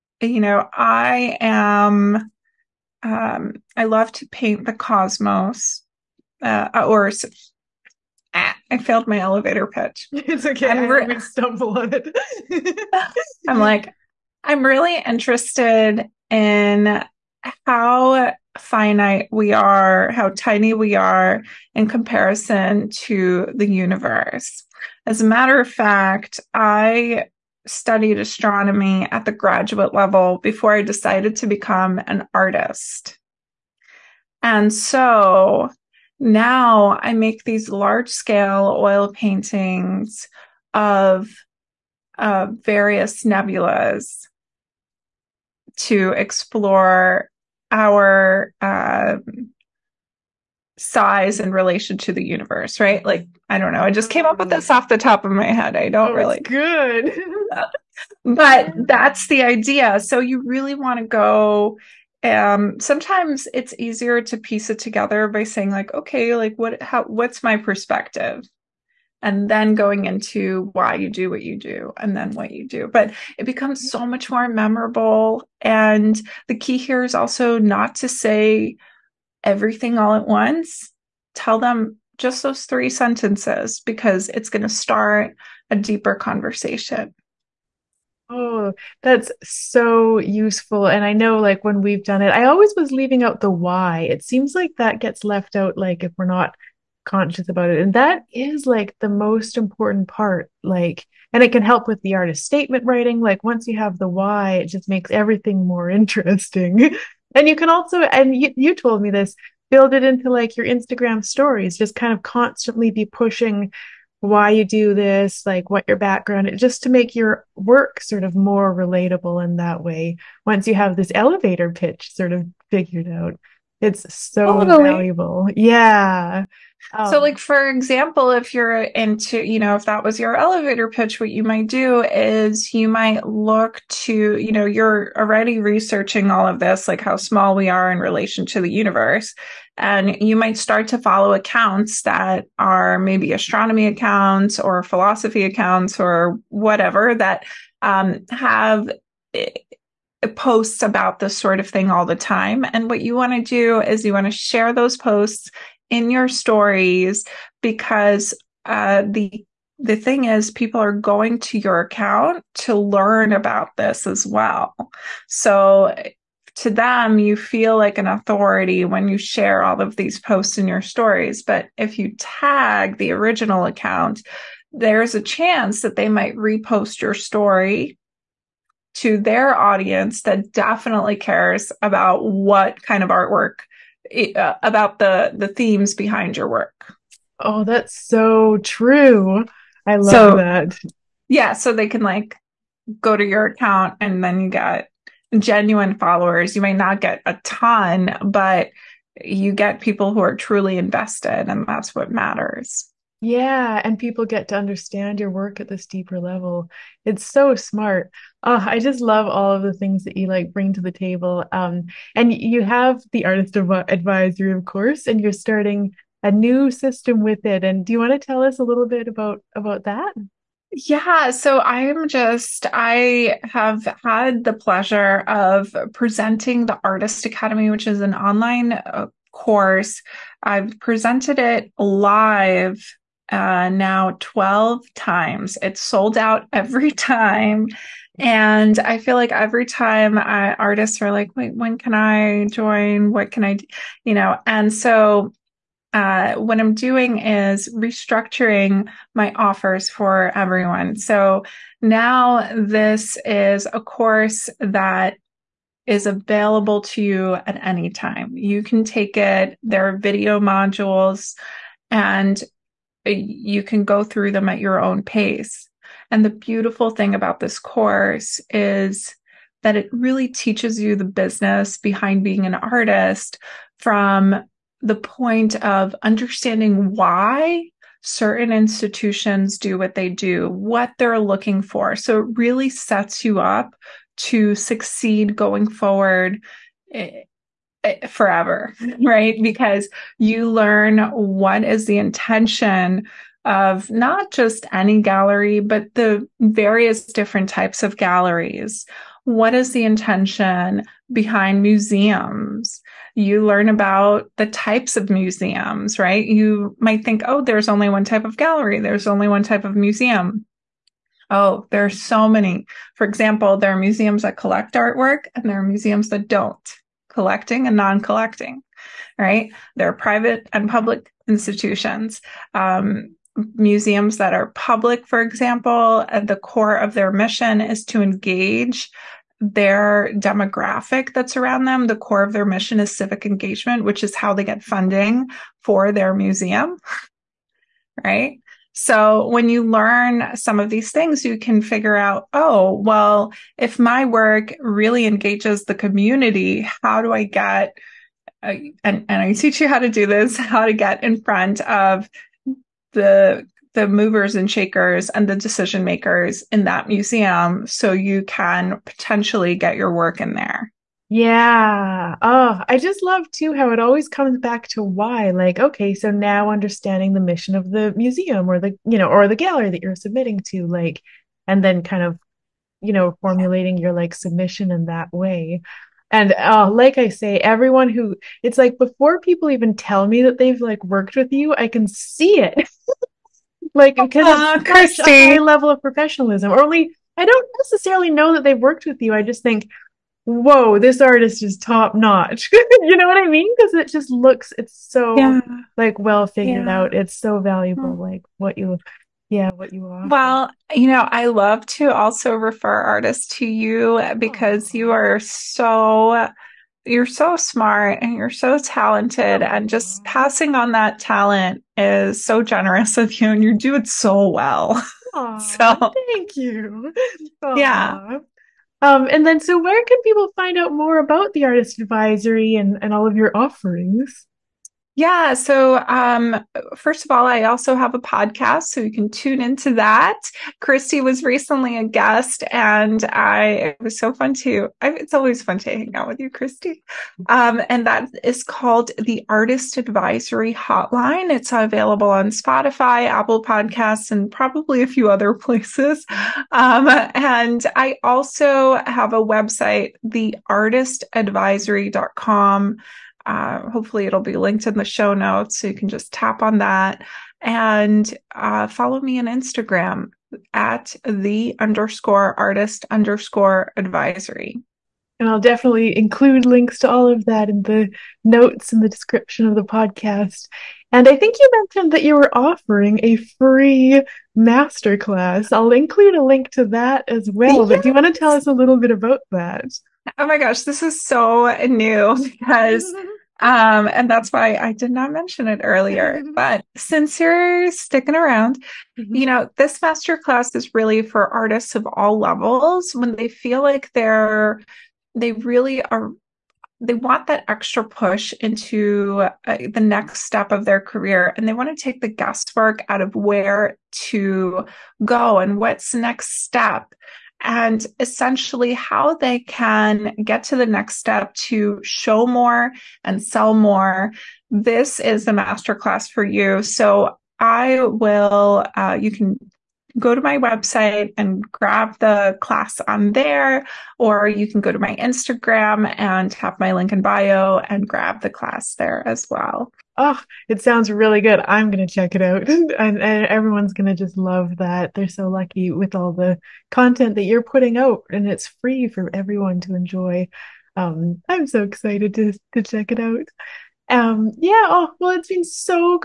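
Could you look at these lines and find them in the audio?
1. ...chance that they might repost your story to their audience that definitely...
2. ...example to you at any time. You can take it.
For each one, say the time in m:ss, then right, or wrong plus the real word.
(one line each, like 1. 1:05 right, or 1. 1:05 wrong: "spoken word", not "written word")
1. 2:55 right
2. 4:16 wrong: "available", not "example".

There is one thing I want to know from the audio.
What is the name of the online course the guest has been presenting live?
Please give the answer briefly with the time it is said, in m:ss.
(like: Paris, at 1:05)
Artist Academy, at 3:46.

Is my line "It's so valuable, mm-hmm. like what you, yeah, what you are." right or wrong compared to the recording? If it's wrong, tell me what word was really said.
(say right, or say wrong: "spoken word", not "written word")
right.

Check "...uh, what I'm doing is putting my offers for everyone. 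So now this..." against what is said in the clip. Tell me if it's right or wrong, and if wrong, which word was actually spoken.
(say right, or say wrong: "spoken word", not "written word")
wrong: "restructuring", not "putting".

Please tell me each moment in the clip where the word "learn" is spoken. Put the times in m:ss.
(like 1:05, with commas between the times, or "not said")
2:42, 4:50, 5:03, 5:39.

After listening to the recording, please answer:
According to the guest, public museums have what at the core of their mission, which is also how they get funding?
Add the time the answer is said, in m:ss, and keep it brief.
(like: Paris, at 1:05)
civic engagement, at 5:32.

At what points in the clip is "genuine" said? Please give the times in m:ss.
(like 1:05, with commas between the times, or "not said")
3:15.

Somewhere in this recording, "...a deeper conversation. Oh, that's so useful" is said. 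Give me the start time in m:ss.
1:25.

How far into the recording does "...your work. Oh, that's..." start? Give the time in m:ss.
3:06.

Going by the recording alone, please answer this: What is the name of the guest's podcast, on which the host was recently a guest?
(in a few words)
Artist Advisory Hotline.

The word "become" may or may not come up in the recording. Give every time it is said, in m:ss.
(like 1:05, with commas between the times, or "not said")
0:31, 1:13.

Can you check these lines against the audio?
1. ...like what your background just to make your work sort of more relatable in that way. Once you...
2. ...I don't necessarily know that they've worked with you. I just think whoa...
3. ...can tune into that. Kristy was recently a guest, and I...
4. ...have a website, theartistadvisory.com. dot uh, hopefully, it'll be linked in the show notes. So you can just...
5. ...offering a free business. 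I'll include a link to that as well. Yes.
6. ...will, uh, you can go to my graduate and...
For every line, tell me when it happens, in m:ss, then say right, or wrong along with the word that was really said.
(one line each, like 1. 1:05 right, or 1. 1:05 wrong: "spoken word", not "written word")
1. 1:55 right
2. 6:27 right
3. 7:08 right
4. 7:28 right
5. 7:52 wrong: "masterclass", not "business"
6. 8:37 wrong: "website", not "graduate".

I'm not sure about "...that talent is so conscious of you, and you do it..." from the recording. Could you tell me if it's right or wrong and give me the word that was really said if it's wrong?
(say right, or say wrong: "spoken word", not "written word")
wrong: "generous", not "conscious".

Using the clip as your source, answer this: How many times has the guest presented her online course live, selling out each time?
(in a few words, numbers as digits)
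12.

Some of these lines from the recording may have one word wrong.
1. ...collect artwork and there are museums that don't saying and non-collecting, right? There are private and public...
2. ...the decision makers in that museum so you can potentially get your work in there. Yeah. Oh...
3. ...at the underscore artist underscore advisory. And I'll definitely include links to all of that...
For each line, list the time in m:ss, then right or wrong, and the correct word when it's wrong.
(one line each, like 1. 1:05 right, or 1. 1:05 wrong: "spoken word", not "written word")
1. 5:14 wrong: "collecting", not "saying"
2. 5:55 right
3. 7:40 right.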